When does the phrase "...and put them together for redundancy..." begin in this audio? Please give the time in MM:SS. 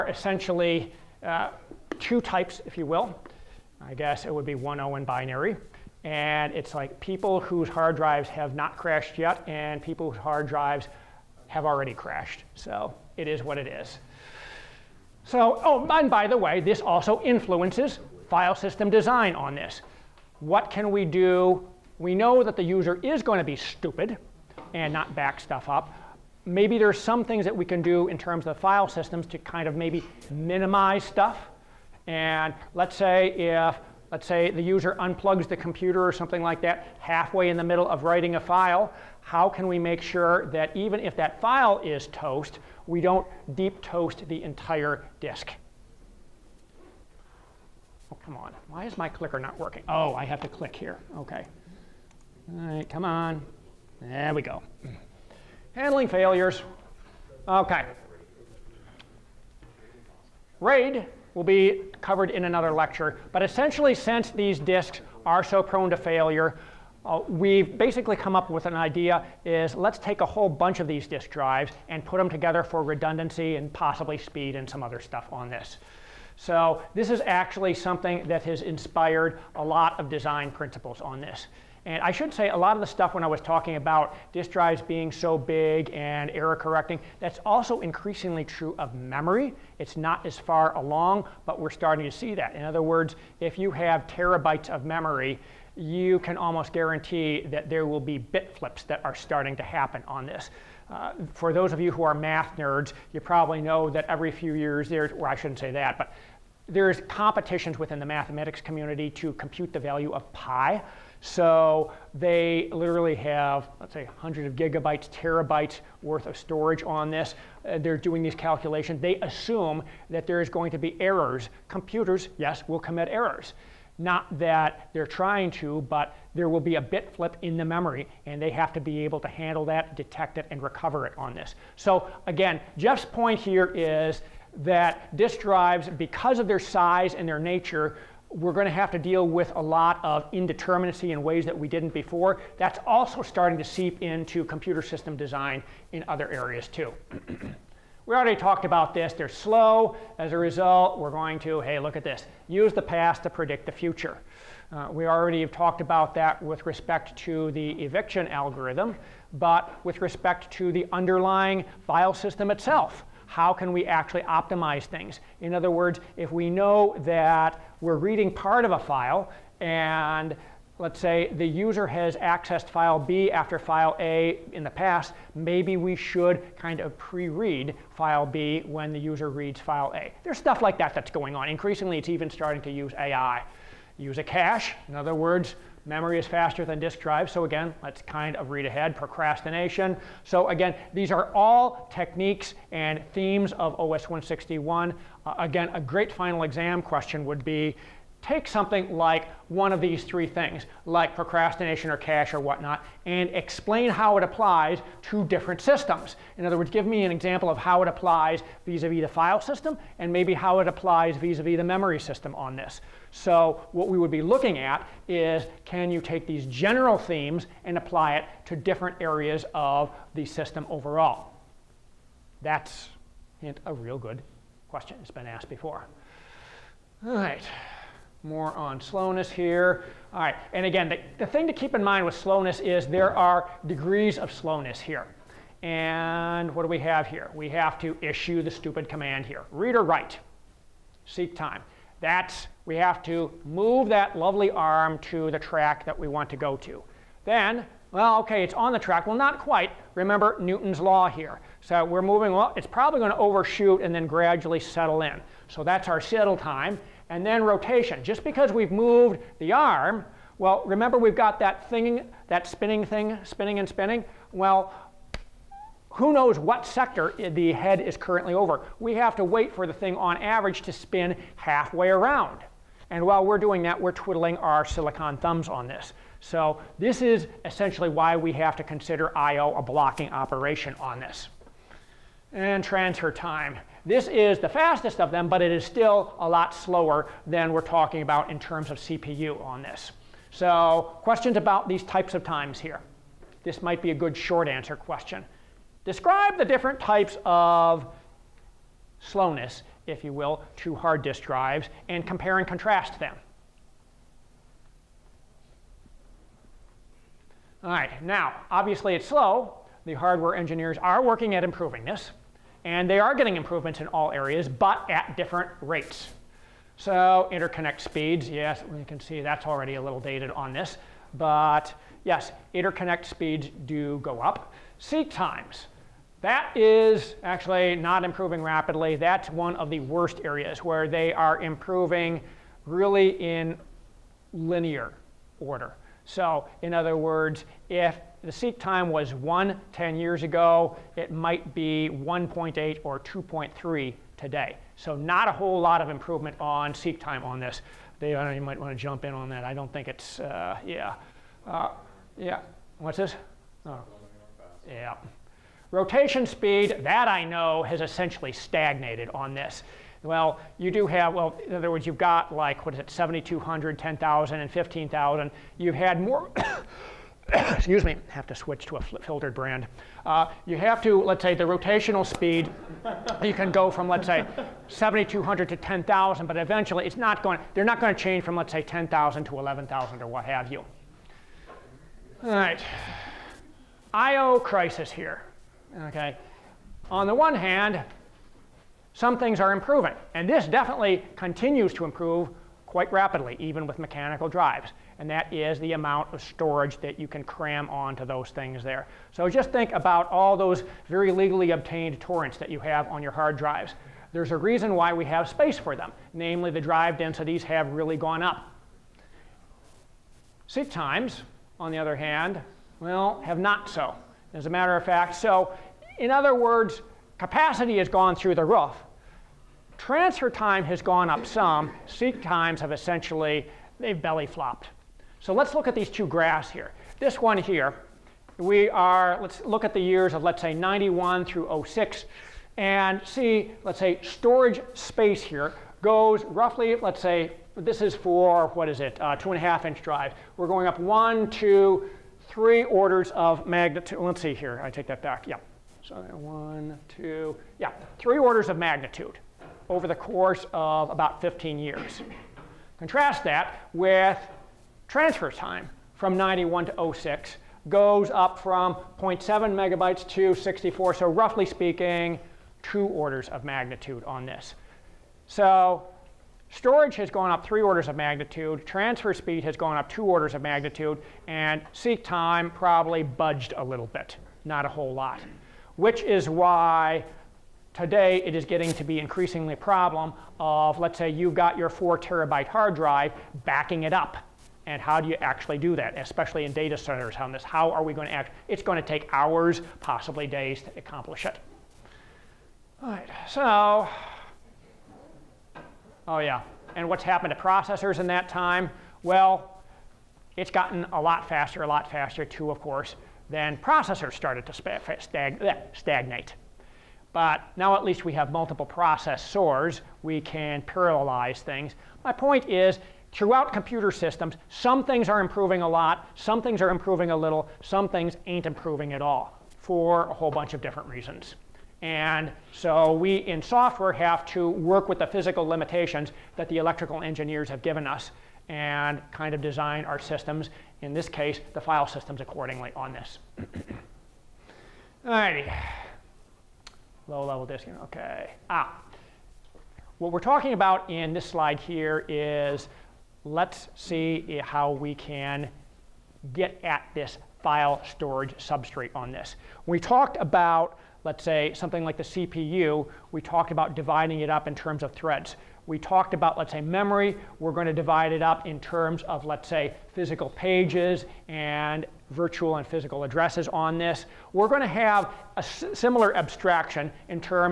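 01:11.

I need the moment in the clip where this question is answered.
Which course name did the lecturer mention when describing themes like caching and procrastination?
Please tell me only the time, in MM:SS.
03:13.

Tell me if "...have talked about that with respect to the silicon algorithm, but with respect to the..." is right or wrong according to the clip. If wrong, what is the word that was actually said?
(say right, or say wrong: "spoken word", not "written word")
wrong: "eviction", not "silicon".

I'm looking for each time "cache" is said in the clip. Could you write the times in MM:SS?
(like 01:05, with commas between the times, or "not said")
03:04, 03:21.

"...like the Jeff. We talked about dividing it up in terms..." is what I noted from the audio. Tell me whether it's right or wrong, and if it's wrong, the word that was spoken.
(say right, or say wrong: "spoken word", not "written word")
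wrong: "CPU", not "Jeff".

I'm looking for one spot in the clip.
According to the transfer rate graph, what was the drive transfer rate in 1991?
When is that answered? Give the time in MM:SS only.
07:38.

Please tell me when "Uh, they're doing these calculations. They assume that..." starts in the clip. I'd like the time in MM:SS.
01:57.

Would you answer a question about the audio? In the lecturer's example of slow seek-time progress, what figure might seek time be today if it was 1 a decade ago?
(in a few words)
1.8.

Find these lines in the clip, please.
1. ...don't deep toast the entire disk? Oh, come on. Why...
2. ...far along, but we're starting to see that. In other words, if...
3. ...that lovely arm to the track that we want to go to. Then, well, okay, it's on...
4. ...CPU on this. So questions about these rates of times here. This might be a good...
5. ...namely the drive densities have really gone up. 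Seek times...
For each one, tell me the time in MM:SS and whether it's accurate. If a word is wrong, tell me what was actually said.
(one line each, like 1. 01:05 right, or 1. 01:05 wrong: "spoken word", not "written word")
1. 00:43 right
2. 01:30 right
3. 04:03 right
4. 04:48 wrong: "types", not "rates"
5. 06:46 right.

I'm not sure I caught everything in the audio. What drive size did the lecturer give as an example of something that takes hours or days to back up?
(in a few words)
4 terabytes.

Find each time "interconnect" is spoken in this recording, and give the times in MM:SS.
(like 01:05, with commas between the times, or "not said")
05:17, 05:22.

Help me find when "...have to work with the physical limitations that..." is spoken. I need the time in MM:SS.
08:43.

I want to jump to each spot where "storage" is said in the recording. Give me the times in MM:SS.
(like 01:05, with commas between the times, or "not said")
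01:56, 06:36, 07:14, 07:46, 09:07.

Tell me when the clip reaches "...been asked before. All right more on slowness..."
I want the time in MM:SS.
03:45.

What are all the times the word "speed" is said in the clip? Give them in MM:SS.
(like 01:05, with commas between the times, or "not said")
01:14, 05:17, 05:23, 05:56, 06:12, 07:49.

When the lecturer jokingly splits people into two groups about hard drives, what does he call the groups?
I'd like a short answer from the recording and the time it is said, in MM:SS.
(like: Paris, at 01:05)
1.0 and binary, at 00:04.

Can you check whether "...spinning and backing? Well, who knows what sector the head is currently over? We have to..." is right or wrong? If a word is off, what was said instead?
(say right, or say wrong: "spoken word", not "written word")
wrong: "spinning", not "backing".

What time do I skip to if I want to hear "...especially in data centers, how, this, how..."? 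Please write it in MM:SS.
08:05.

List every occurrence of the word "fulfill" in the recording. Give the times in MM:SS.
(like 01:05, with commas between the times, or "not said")
not said.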